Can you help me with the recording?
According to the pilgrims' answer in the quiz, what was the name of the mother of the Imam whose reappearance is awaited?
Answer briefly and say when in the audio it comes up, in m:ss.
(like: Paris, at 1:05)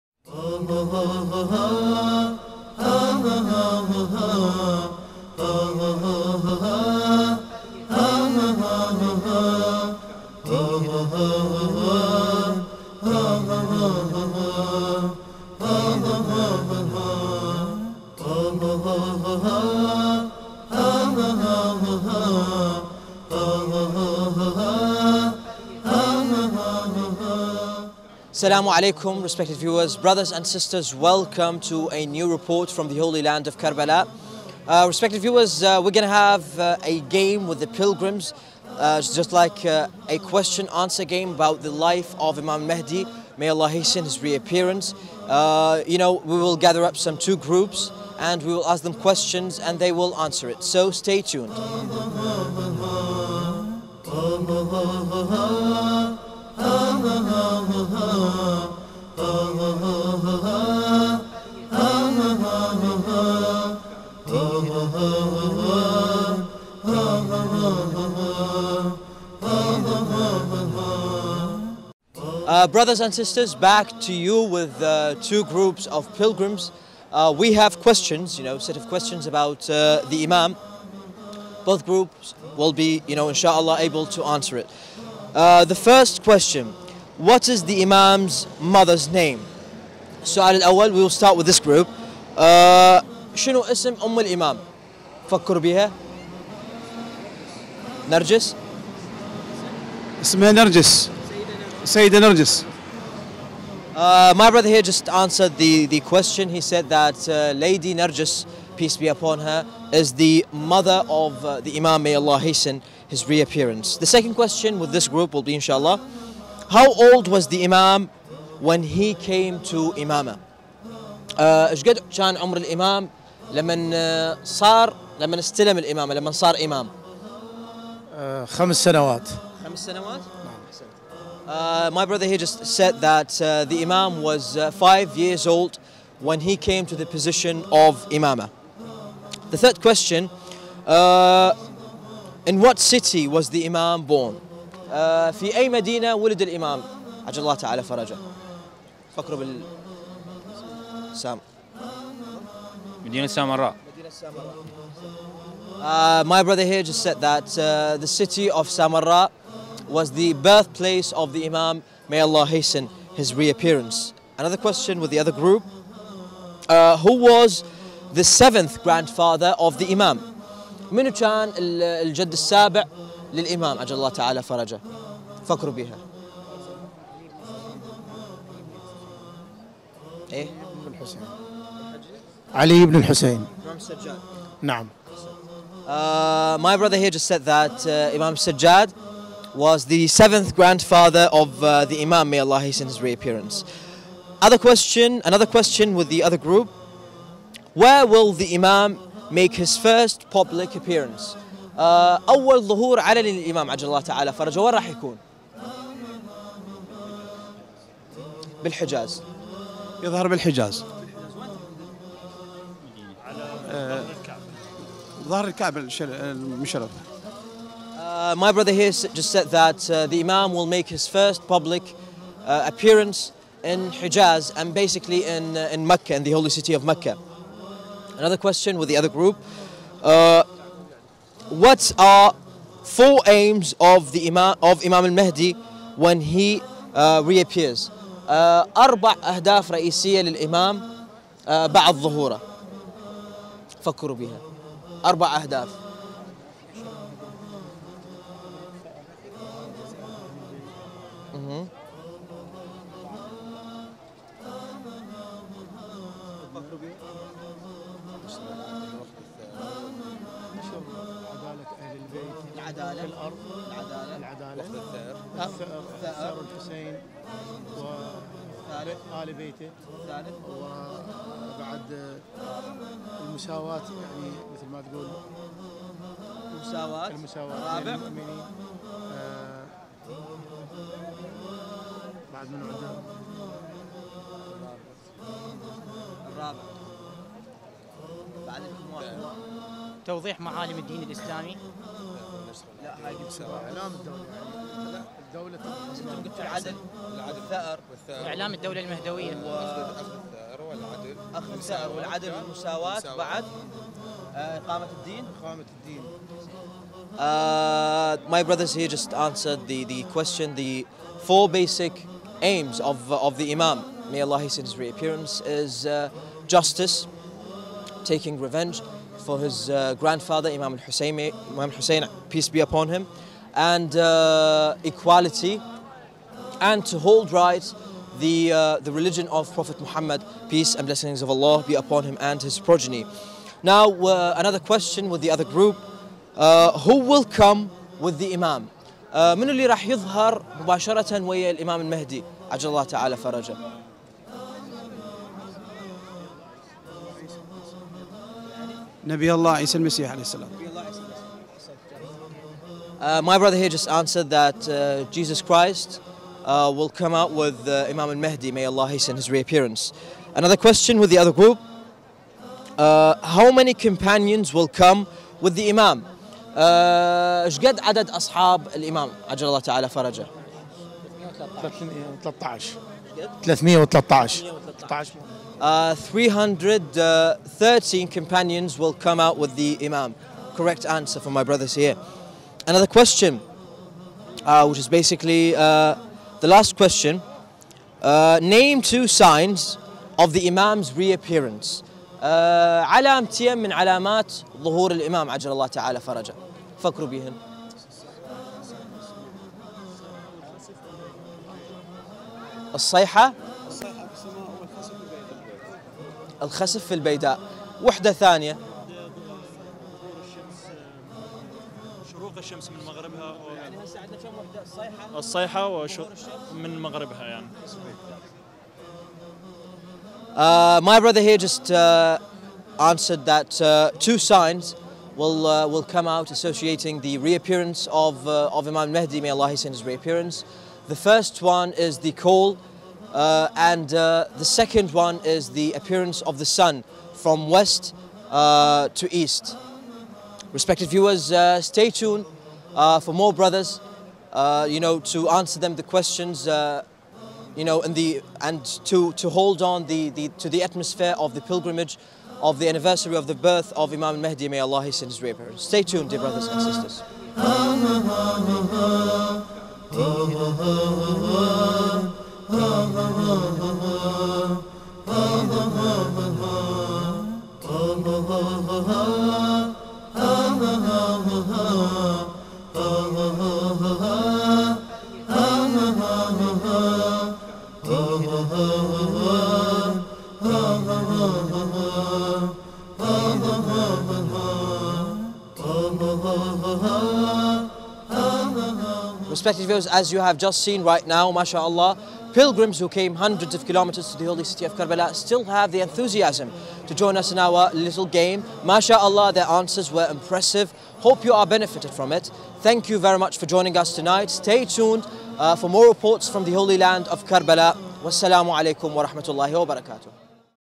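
Lady Nargis, at 1:47.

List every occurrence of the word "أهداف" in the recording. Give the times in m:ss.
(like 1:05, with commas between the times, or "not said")
3:59, 4:05.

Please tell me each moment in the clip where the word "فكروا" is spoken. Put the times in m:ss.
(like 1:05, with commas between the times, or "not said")
2:29, 2:55, 4:03, 6:36.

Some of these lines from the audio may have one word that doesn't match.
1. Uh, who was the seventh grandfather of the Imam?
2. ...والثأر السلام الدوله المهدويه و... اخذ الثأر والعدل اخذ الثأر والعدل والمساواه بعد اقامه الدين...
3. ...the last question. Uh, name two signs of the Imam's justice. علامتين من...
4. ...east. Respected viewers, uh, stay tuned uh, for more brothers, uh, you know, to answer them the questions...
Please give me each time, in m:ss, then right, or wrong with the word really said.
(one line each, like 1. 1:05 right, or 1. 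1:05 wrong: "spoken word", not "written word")
1. 2:46 right
2. 4:57 wrong: "اعلام", not "السلام"
3. 6:26 wrong: "reappearance", not "justice"
4. 7:19 right.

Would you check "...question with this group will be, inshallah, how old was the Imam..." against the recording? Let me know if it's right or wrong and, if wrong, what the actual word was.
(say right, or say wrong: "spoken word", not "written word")
right.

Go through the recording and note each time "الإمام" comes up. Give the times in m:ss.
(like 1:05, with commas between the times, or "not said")
1:34, 2:26, 5:41, 6:34.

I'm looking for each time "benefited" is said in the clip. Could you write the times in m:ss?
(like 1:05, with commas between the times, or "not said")
8:21.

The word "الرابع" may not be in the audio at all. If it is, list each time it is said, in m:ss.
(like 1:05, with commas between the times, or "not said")
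4:37, 4:46.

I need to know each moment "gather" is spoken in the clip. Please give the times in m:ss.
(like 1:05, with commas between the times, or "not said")
0:46.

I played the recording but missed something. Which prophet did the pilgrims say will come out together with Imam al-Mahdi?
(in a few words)
Jesus Christ.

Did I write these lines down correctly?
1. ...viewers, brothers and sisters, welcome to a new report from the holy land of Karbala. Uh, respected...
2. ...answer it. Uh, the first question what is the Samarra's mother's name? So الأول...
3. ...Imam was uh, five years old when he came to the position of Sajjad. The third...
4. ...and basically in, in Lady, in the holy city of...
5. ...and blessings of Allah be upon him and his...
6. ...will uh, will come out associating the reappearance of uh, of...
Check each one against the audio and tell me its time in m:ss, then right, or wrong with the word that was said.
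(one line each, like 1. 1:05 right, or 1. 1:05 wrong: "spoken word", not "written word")
1. 0:29 right
2. 1:24 wrong: "Imam", not "Samarra"
3. 2:13 wrong: "Imama", not "Sajjad"
4. 3:44 wrong: "Mecca", not "Lady"
5. 5:30 right
6. 7:05 right.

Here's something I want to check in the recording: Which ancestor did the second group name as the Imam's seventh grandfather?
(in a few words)
Imam Sajjad.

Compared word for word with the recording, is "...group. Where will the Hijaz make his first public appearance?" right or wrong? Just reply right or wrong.
wrong.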